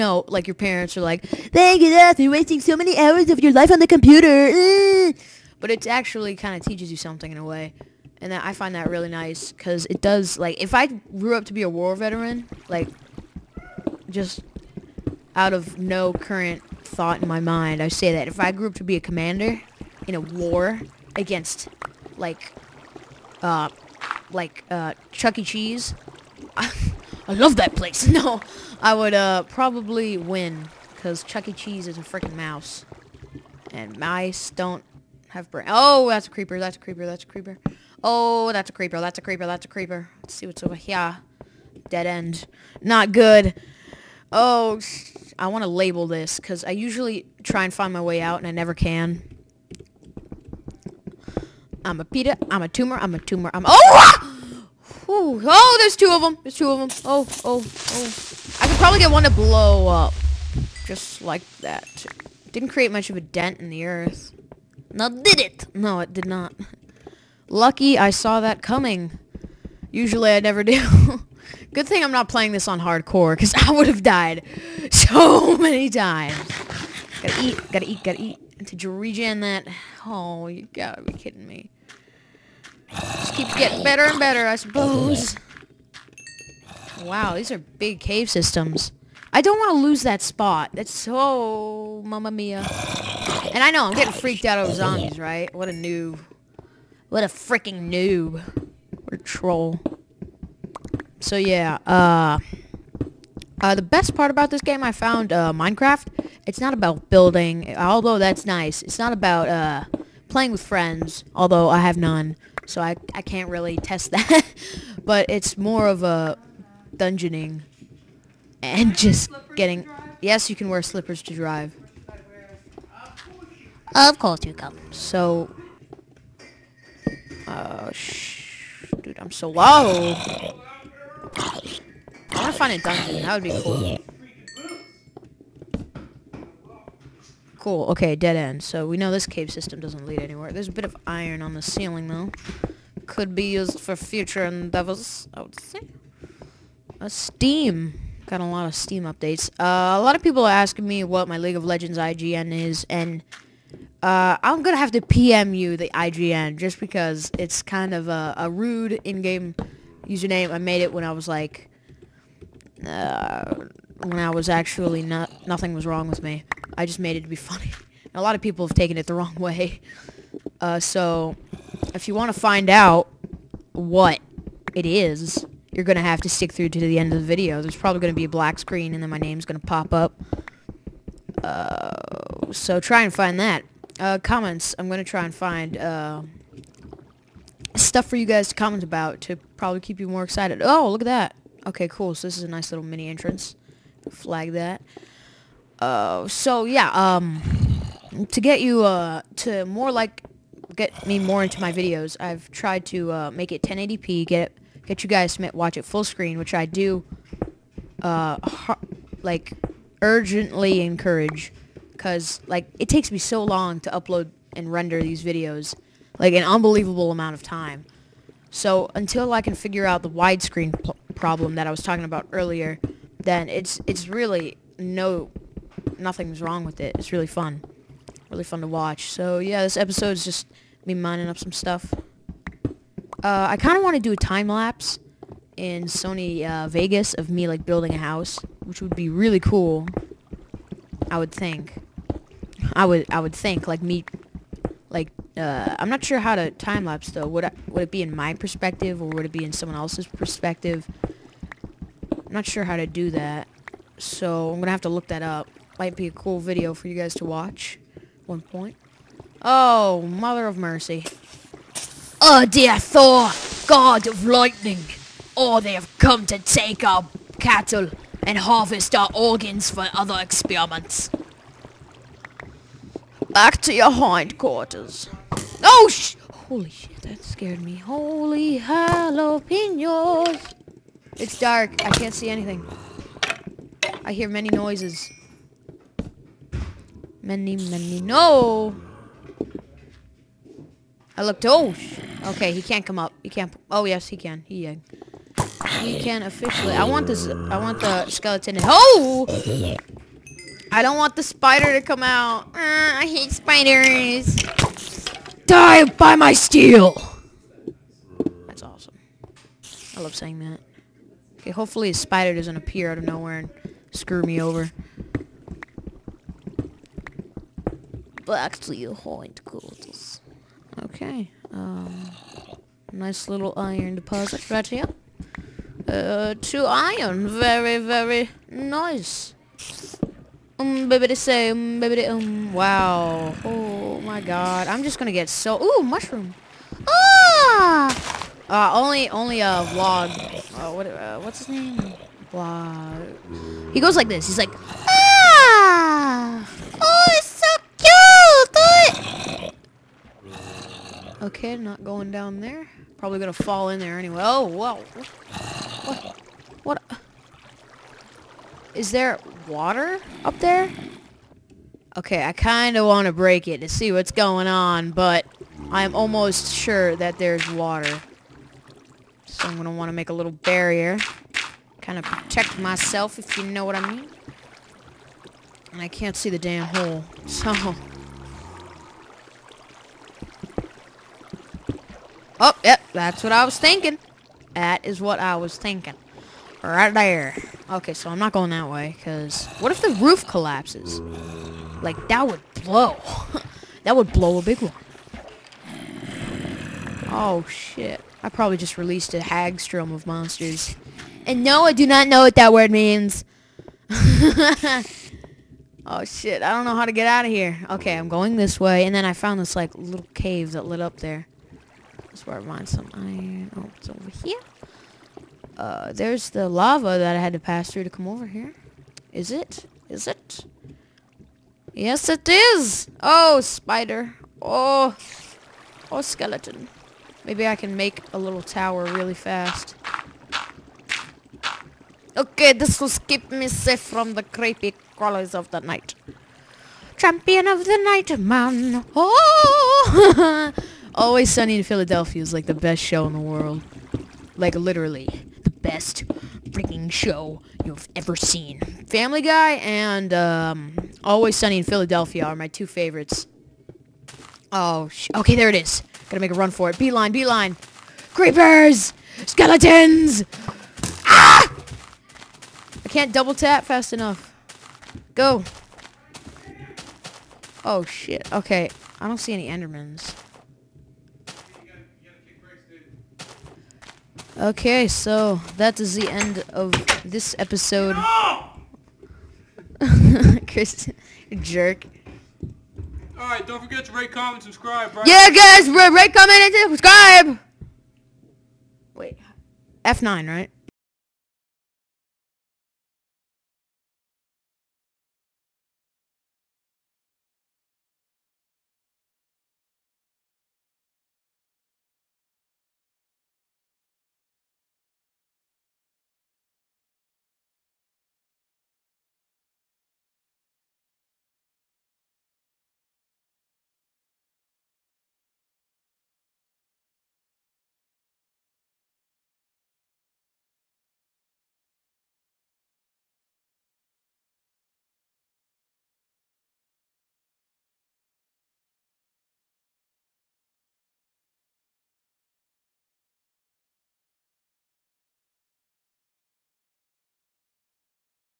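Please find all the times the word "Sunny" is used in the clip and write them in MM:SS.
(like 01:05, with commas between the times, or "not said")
07:21, 07:31.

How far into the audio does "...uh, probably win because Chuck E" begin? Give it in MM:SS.
00:29.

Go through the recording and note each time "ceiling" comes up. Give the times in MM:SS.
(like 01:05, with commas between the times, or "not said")
02:21.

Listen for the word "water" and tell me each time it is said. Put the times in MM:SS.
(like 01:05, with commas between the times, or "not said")
05:59, 06:07.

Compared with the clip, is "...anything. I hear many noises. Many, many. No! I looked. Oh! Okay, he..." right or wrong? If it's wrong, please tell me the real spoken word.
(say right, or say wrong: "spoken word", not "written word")
right.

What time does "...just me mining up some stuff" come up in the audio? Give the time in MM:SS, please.
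03:50.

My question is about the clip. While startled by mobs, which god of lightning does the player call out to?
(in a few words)
Thor.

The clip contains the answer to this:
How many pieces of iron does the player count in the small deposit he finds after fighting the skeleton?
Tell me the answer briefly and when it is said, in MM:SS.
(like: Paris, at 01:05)
2, at 05:26.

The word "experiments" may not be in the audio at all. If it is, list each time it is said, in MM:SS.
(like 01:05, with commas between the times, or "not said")
04:30.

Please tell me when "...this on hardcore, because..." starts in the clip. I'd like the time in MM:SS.
01:12.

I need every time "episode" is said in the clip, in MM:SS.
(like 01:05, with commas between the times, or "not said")
03:49, 07:57.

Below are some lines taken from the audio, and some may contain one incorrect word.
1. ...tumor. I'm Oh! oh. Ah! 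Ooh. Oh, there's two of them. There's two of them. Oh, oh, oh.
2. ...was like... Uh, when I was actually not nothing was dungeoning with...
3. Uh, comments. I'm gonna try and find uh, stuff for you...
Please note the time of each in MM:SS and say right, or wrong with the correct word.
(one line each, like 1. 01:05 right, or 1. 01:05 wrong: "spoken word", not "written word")
1. 00:53 right
2. 02:41 wrong: "wrong", not "dungeoning"
3. 03:03 right.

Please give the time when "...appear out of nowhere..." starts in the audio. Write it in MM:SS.
05:12.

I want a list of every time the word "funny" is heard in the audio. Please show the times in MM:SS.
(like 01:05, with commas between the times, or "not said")
02:47.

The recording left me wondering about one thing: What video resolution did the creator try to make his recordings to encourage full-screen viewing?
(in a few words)
1080p.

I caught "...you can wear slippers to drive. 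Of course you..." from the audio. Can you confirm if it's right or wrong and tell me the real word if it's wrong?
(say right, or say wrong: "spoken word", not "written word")
right.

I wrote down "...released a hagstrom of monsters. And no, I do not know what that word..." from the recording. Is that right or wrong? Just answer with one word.
right.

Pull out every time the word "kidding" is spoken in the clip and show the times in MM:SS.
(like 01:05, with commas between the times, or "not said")
01:21.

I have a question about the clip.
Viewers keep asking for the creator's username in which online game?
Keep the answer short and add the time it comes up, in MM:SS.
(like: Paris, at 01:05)
League of Legends, at 02:31.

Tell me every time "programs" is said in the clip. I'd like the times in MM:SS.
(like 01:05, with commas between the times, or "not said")
not said.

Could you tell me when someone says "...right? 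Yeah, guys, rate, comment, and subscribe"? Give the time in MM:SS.
08:04.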